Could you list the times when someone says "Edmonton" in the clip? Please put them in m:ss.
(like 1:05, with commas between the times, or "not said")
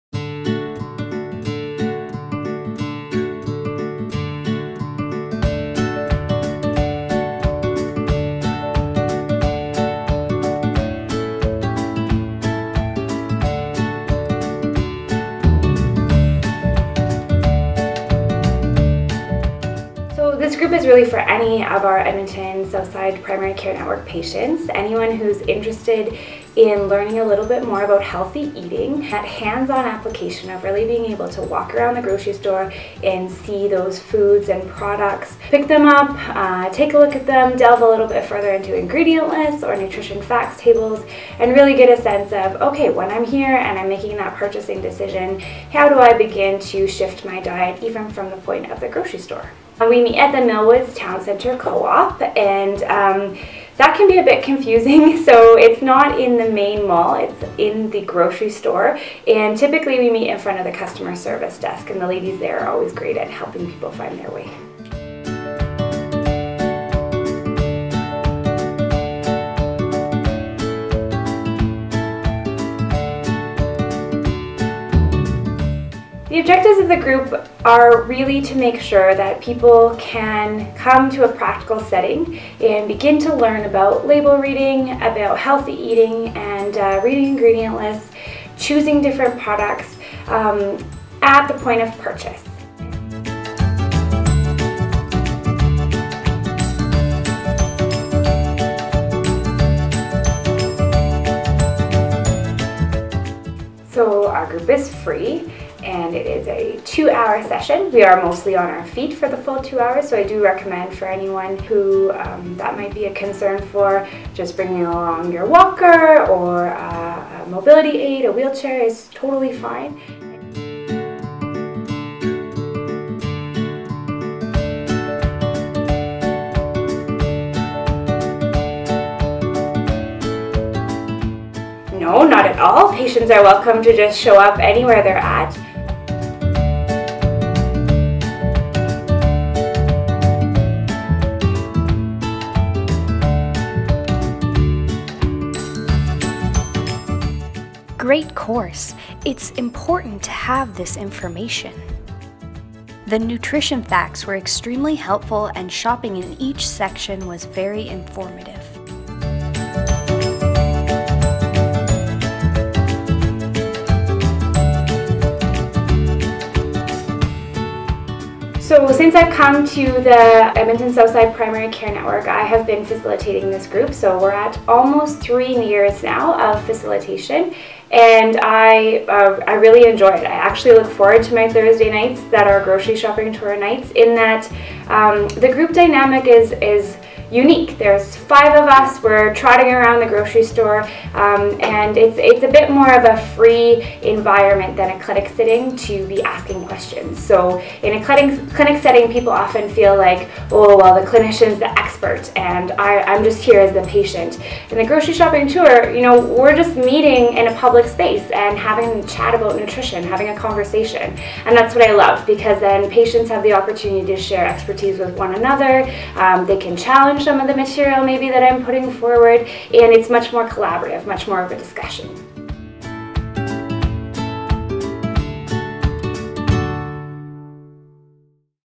0:21, 2:50.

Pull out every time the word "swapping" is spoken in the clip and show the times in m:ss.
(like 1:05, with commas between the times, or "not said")
not said.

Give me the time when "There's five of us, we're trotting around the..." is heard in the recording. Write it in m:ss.
3:07.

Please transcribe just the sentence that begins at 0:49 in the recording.
We meet at the Millwoods Town Center Co-op and um, that can be a bit confusing.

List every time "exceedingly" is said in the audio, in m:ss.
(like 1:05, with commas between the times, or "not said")
not said.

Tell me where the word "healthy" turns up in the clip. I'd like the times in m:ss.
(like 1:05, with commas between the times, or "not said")
0:28, 1:25.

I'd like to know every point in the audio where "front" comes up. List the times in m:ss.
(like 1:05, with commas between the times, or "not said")
1:00.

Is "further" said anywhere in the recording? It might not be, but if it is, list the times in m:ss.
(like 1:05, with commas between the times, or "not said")
0:38.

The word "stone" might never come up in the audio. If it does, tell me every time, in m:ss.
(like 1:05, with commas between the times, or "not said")
not said.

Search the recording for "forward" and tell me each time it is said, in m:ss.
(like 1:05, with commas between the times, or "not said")
3:00, 3:38.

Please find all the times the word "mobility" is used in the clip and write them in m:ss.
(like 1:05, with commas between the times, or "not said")
1:57.